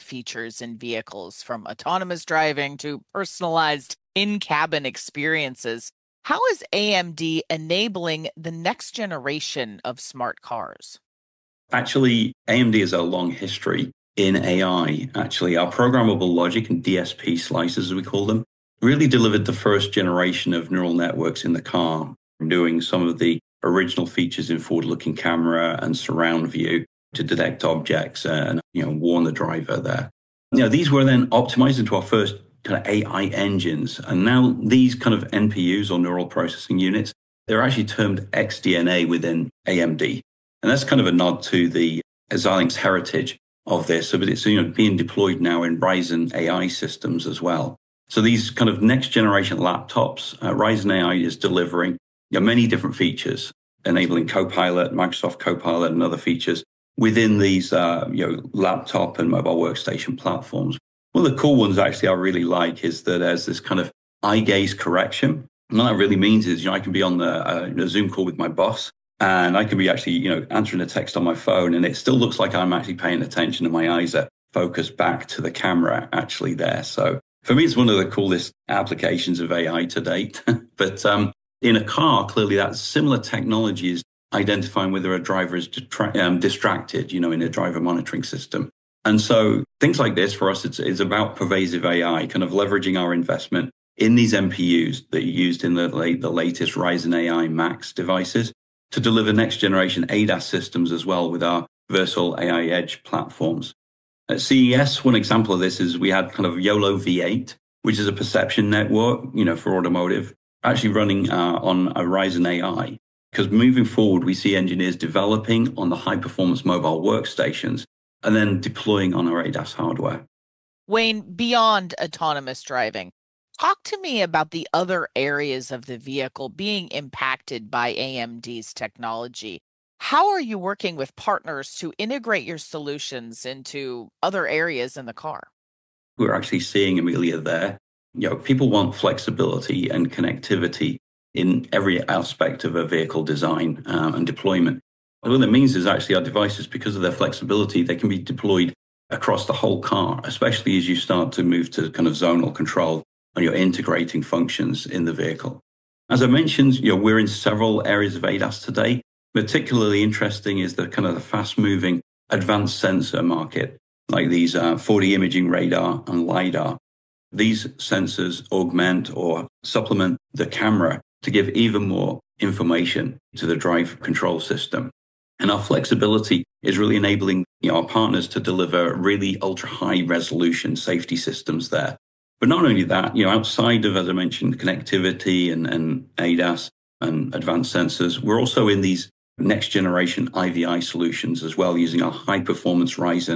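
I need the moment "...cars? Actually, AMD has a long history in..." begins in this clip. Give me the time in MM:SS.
00:10.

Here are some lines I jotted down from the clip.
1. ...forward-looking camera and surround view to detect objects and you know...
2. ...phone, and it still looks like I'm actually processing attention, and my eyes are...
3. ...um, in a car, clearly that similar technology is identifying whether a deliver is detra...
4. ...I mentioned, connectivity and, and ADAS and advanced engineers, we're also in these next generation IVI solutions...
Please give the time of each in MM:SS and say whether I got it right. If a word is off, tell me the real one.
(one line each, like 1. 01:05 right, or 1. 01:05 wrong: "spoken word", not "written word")
1. 00:24 right
2. 01:11 wrong: "paying", not "processing"
3. 01:21 wrong: "driver", not "deliver"
4. 03:04 wrong: "sensors", not "engineers".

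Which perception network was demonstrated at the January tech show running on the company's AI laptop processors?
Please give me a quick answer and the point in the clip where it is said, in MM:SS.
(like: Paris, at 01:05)
YOLO V8, at 01:46.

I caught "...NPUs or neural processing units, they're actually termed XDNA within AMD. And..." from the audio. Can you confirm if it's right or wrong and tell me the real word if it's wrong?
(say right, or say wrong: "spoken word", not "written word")
right.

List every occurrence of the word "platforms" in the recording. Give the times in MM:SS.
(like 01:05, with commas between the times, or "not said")
01:00, 01:43.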